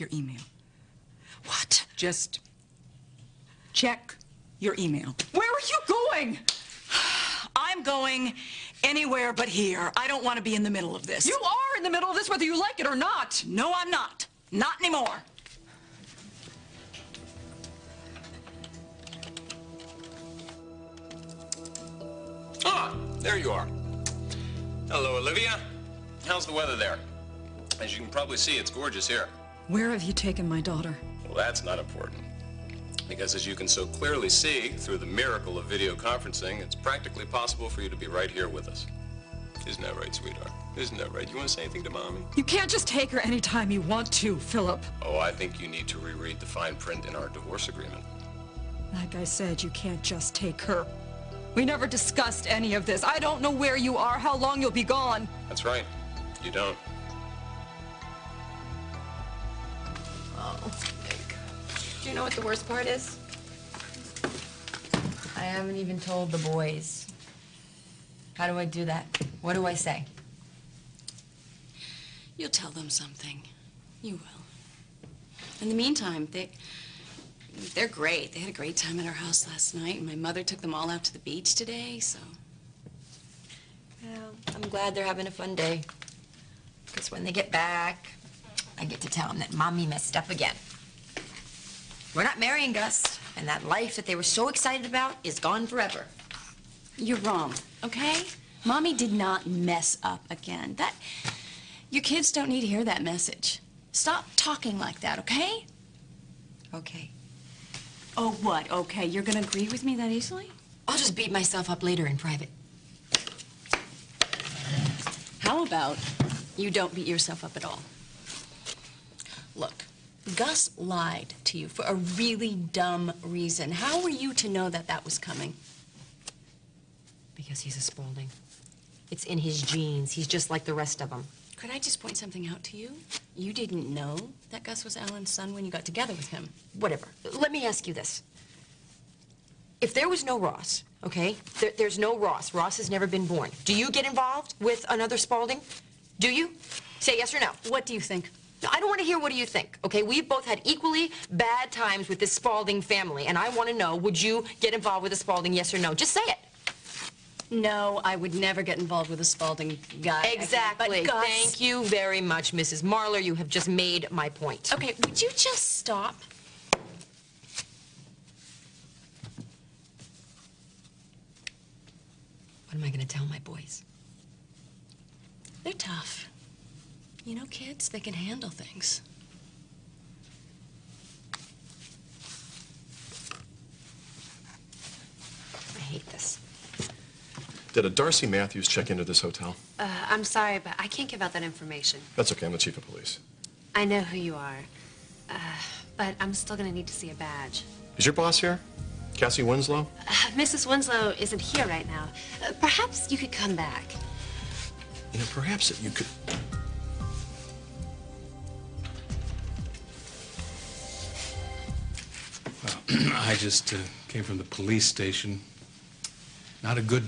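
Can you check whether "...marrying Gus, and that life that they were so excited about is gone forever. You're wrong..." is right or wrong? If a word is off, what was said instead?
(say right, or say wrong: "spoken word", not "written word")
right.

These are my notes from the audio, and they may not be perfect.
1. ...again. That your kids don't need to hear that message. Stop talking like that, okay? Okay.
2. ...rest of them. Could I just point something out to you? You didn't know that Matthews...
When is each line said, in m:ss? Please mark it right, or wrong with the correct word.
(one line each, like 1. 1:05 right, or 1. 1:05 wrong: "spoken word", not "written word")
1. 1:40 right
2. 2:10 wrong: "Gus", not "Matthews".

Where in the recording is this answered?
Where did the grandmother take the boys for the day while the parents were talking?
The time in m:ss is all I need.
1:21.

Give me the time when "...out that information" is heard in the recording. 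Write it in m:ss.
3:11.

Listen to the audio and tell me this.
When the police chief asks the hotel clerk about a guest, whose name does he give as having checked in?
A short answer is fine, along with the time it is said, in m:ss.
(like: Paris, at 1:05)
Darcy Matthews, at 3:07.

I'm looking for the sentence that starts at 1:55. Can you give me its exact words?
How about you don't beat yourself up at all?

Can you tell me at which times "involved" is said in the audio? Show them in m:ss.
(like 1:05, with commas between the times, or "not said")
2:24, 2:34, 2:38.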